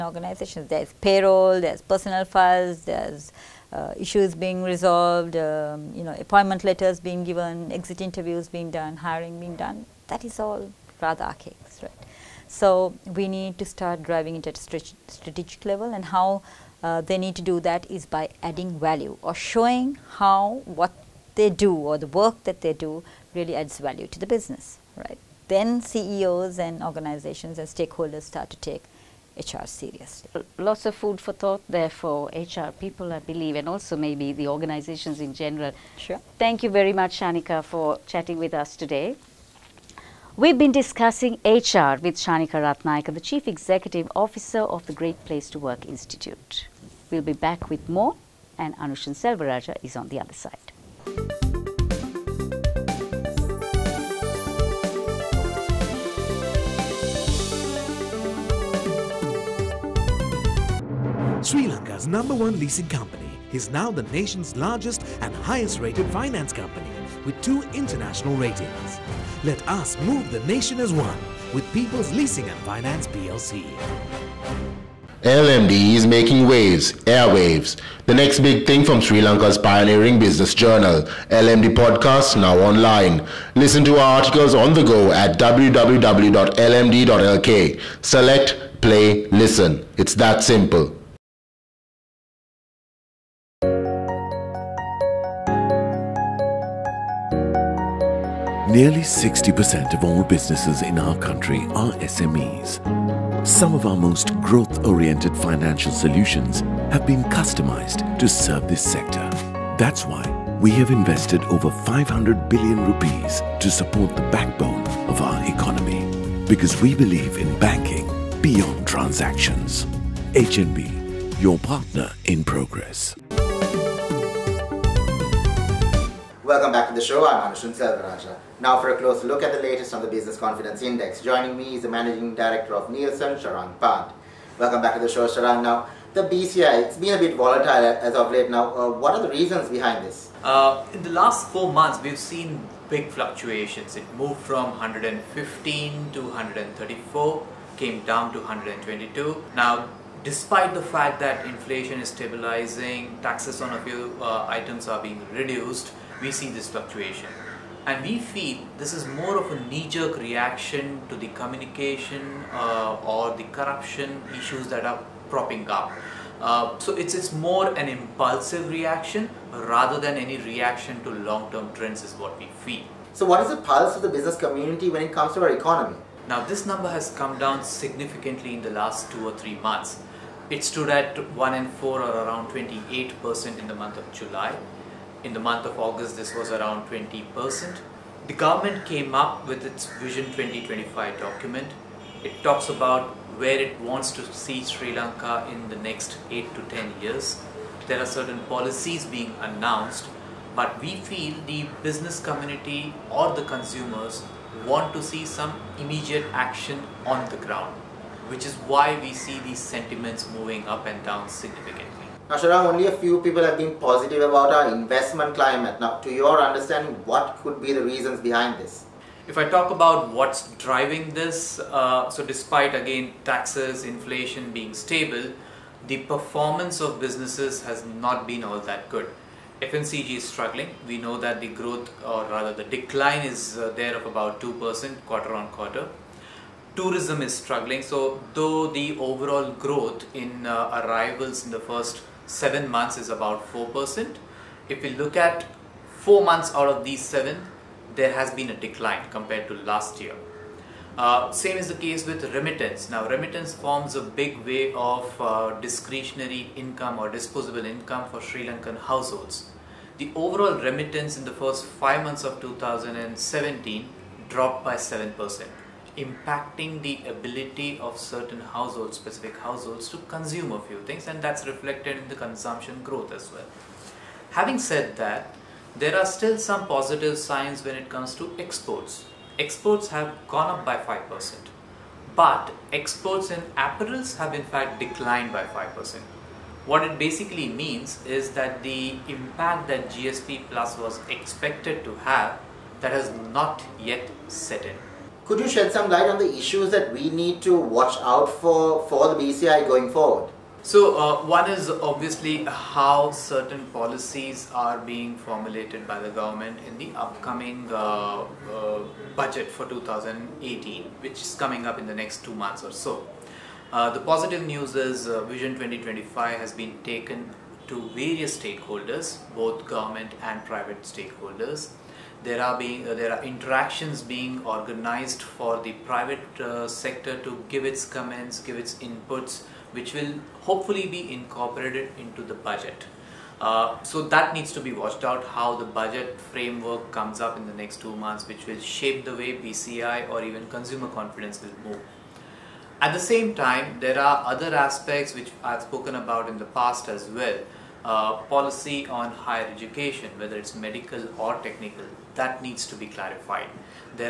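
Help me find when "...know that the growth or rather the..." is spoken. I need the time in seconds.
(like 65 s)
230 s.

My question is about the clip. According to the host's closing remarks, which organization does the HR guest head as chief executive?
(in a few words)
Great Place to Work Institute.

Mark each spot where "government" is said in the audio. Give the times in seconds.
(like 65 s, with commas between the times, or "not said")
188 s, 306 s, 319 s.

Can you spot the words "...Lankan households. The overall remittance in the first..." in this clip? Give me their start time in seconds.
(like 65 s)
258 s.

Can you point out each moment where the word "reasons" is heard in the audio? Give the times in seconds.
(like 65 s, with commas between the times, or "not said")
139 s, 217 s.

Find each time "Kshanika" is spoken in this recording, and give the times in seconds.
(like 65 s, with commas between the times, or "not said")
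37 s, 42 s.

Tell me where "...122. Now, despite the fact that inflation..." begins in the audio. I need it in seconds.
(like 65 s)
148 s.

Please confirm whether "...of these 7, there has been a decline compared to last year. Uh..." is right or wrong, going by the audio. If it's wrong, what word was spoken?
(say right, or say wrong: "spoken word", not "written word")
right.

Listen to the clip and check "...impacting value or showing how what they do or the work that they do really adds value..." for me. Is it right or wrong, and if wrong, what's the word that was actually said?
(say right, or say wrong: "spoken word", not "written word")
wrong: "adding", not "impacting".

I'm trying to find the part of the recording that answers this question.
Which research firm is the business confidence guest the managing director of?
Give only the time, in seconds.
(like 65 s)
132 s.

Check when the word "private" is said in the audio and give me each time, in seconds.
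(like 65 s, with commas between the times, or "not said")
320 s, 325 s.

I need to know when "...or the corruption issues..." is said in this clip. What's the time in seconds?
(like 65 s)
163 s.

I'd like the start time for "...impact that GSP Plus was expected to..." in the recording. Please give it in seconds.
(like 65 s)
289 s.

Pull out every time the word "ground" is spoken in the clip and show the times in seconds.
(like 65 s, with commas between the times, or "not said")
207 s.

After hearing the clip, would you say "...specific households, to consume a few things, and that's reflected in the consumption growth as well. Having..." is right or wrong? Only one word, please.
right.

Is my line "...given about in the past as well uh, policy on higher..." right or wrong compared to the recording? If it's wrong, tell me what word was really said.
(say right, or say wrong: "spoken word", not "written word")
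wrong: "spoken", not "given".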